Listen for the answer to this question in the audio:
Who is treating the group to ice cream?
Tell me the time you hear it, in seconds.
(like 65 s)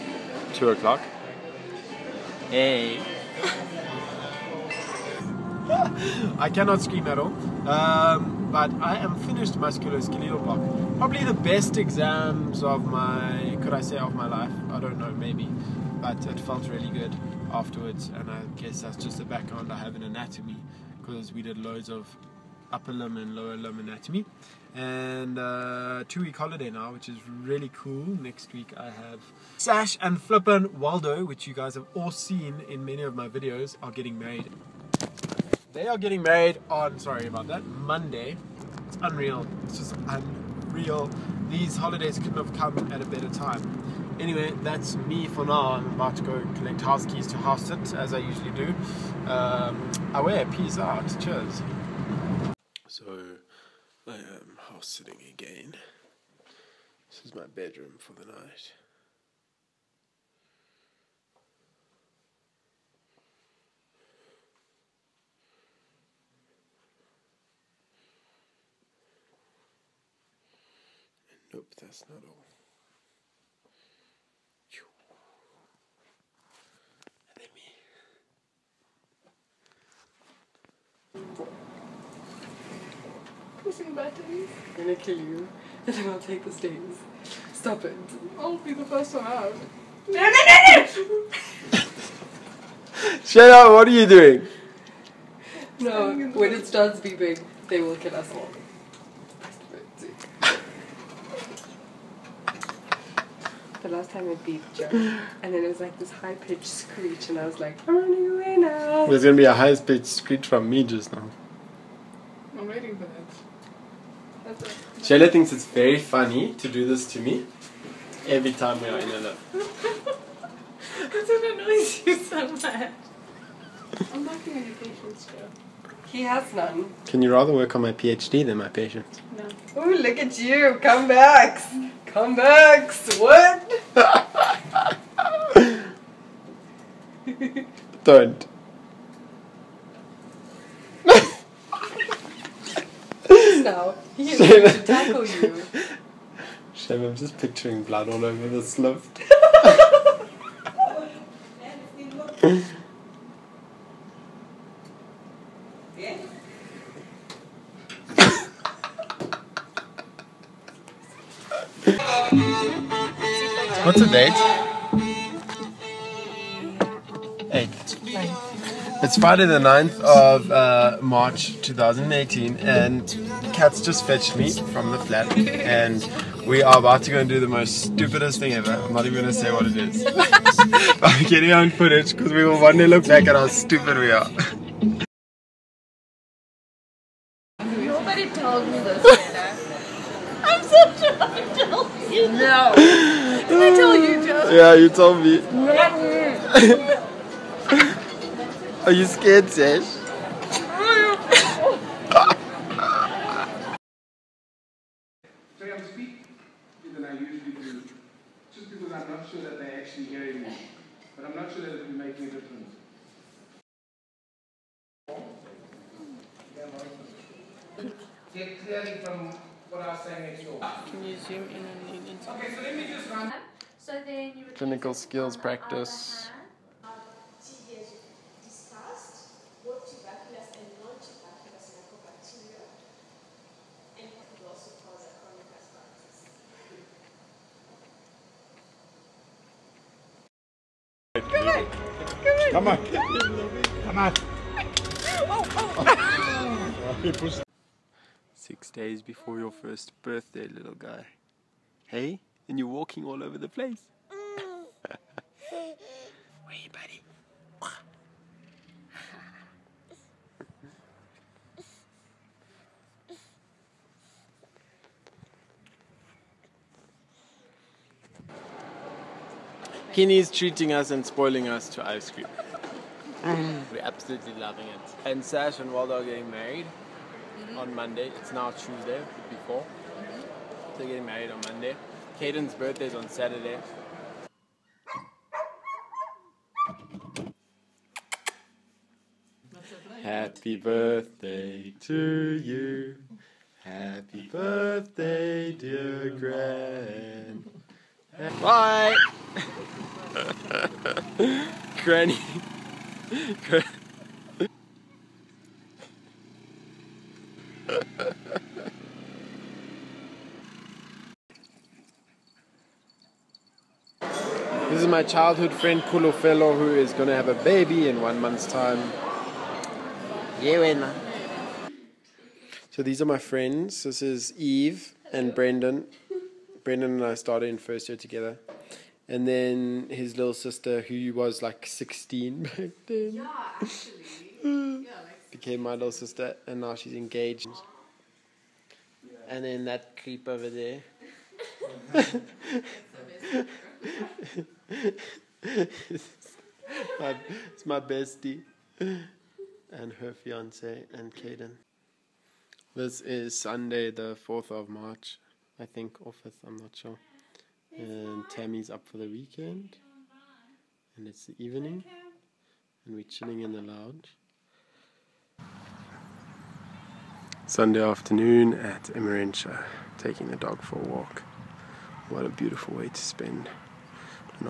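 269 s.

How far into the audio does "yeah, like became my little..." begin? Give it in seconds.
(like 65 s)
334 s.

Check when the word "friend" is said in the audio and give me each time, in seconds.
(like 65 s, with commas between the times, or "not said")
315 s, 323 s.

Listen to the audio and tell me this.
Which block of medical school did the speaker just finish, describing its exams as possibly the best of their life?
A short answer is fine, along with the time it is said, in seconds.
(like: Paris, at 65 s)
Musculoskeletal, at 9 s.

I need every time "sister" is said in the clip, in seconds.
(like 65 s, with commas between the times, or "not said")
330 s, 335 s.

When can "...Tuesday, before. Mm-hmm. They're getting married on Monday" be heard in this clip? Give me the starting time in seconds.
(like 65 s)
278 s.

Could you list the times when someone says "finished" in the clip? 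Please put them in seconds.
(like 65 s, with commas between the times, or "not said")
9 s.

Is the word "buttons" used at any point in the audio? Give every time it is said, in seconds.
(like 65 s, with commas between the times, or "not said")
83 s.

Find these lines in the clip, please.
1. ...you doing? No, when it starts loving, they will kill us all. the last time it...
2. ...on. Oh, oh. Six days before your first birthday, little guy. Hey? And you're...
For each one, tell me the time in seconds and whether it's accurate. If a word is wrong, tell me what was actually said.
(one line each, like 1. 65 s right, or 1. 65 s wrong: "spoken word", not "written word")
1. 93 s wrong: "beeping", not "loving"
2. 243 s right.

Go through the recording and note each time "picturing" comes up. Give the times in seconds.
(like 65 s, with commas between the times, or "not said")
147 s.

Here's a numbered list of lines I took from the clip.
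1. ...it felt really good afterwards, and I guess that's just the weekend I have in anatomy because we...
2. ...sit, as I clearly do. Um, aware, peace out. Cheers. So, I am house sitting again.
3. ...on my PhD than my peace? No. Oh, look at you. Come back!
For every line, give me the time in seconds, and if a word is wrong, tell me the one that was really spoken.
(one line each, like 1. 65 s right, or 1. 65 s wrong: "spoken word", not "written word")
1. 16 s wrong: "background", not "weekend"
2. 47 s wrong: "usually", not "clearly"
3. 127 s wrong: "patience", not "peace".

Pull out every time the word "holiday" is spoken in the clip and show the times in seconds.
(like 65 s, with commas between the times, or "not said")
26 s, 41 s.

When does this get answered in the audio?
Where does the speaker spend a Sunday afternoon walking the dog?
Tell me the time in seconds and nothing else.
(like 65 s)
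368 s.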